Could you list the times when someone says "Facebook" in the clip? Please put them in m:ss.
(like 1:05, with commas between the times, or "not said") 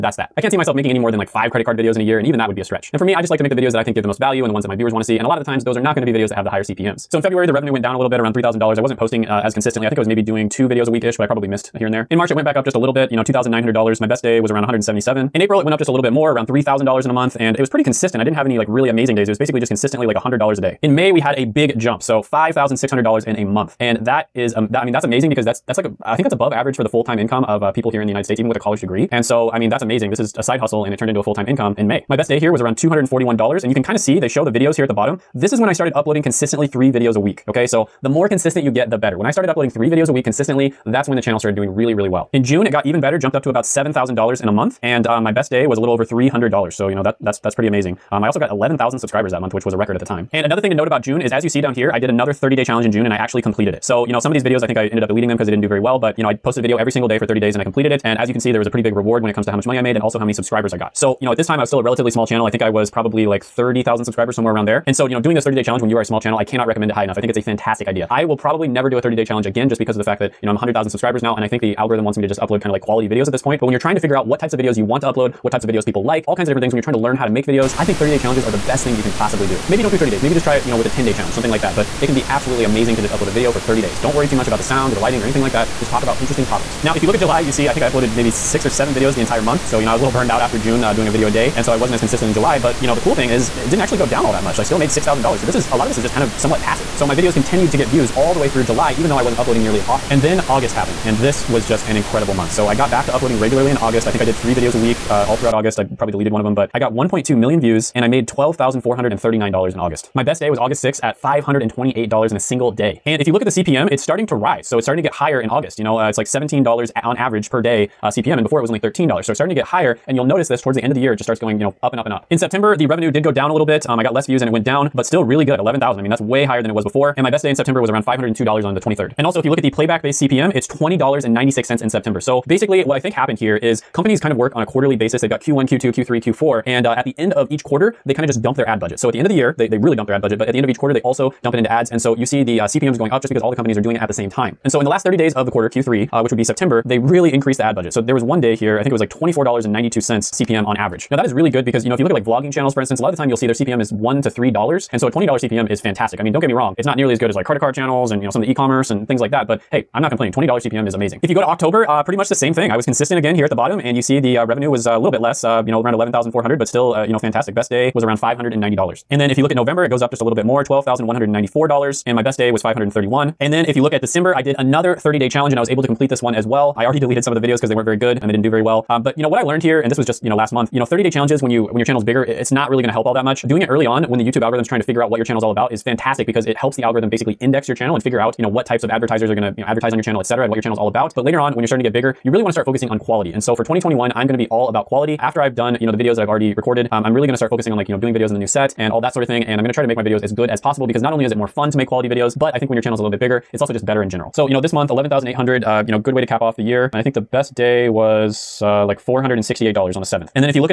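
not said.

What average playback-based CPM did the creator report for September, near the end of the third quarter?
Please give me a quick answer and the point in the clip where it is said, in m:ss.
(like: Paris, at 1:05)
$20.96, at 2:10.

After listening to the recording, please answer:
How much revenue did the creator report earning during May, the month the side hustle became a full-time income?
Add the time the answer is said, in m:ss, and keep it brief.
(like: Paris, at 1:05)
$5,600, at 0:22.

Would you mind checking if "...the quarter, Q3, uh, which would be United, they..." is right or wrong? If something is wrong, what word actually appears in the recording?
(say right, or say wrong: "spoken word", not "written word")
wrong: "September", not "United".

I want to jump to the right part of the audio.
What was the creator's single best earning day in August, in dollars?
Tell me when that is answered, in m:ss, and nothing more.
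1:51.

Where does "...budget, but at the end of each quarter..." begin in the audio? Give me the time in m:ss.
2:20.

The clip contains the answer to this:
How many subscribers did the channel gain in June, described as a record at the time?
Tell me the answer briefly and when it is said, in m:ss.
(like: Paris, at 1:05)
11,000, at 0:48.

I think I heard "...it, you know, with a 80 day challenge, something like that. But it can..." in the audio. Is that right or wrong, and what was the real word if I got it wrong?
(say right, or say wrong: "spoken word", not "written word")
wrong: "10", not "80".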